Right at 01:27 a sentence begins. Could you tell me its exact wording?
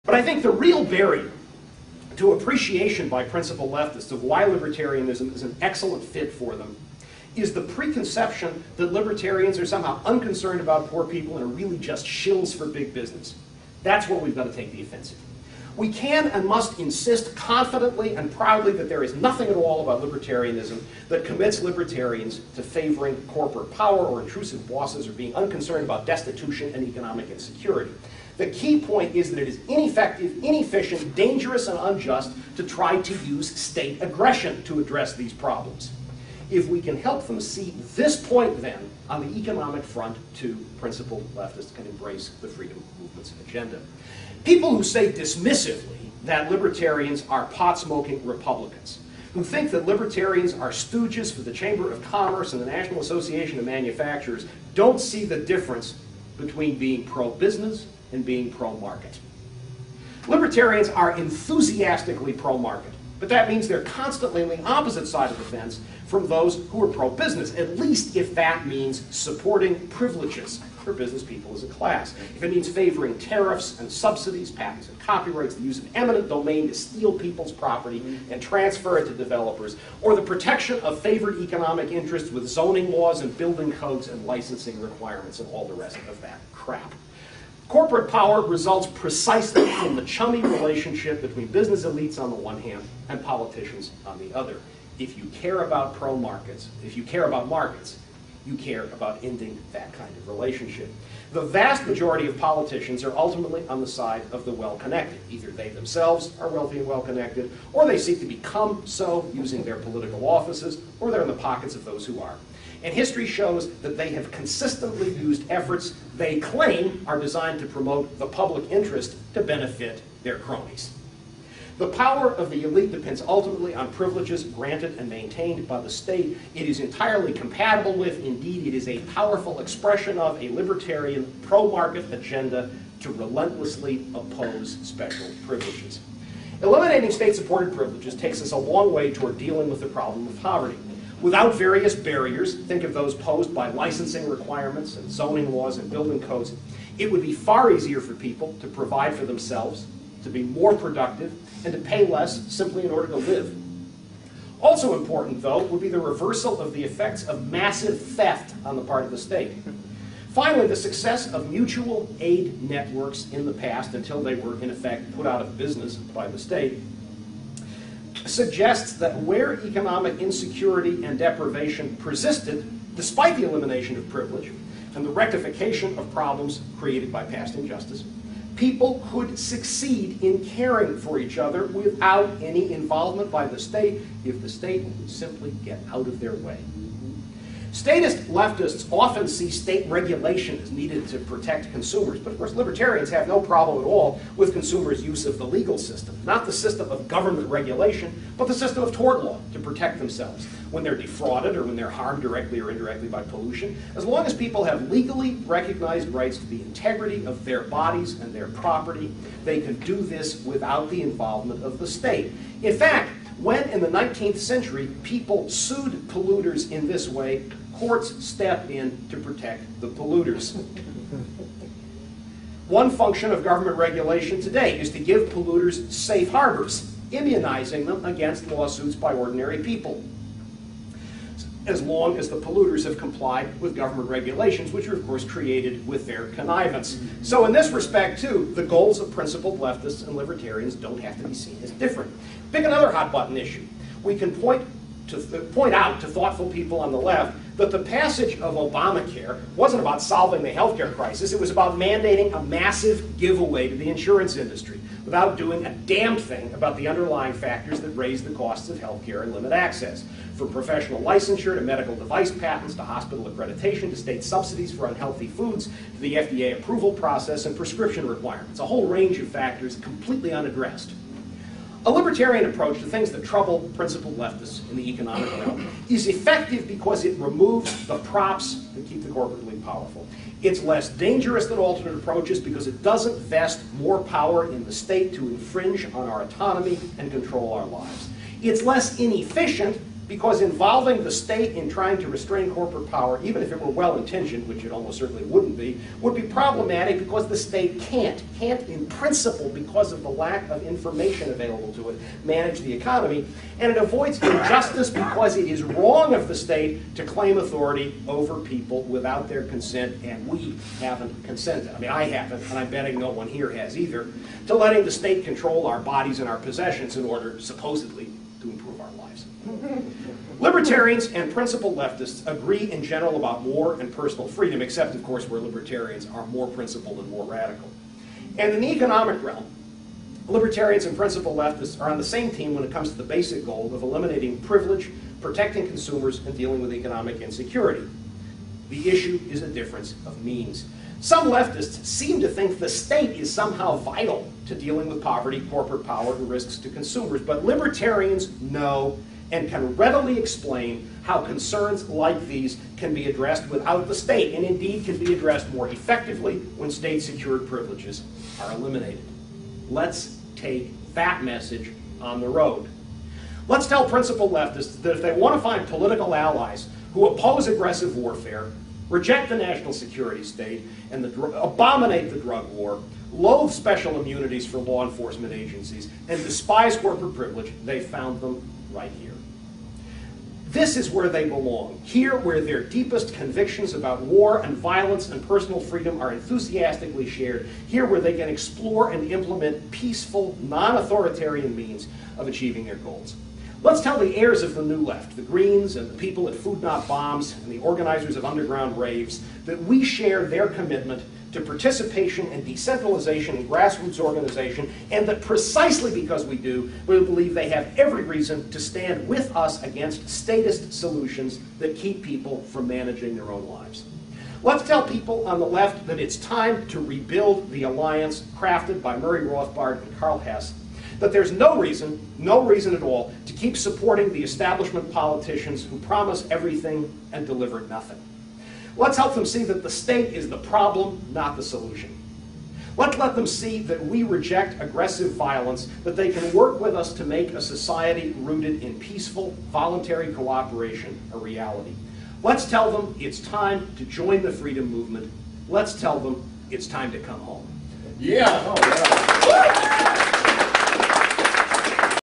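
Corporate power results precisely from the chummy relationship between business elites on the one hand and politicians on the other.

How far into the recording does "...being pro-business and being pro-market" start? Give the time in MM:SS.
00:56.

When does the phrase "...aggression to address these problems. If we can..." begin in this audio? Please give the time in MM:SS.
00:34.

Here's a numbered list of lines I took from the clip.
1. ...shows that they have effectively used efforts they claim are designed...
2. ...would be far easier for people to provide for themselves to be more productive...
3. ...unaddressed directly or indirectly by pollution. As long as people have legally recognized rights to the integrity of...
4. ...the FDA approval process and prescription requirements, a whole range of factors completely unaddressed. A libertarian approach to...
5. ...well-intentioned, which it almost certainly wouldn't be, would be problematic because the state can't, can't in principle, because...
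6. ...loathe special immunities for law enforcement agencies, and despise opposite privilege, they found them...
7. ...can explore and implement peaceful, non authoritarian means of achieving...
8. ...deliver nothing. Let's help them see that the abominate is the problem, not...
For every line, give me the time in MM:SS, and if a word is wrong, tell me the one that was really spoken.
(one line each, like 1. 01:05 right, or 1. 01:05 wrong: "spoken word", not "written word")
1. 01:53 wrong: "consistently", not "effectively"
2. 02:27 right
3. 03:21 wrong: "harmed", not "unaddressed"
4. 04:25 right
5. 04:53 right
6. 06:13 wrong: "corporate", not "opposite"
7. 06:28 right
8. 07:07 wrong: "state", not "abominate".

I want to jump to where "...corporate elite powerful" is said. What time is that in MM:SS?
04:39.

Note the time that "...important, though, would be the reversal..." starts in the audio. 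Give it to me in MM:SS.
02:34.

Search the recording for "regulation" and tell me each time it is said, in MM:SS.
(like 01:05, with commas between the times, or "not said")
03:09, 03:17, 03:43, 03:54.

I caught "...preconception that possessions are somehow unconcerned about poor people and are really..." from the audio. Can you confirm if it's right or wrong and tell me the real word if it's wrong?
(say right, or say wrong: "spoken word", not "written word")
wrong: "libertarians", not "possessions".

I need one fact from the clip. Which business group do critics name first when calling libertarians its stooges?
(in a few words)
Chamber of Commerce.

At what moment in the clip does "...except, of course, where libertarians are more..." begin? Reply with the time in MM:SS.
05:24.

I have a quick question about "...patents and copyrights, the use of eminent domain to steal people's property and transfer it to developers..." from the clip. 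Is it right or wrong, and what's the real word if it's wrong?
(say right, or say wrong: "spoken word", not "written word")
right.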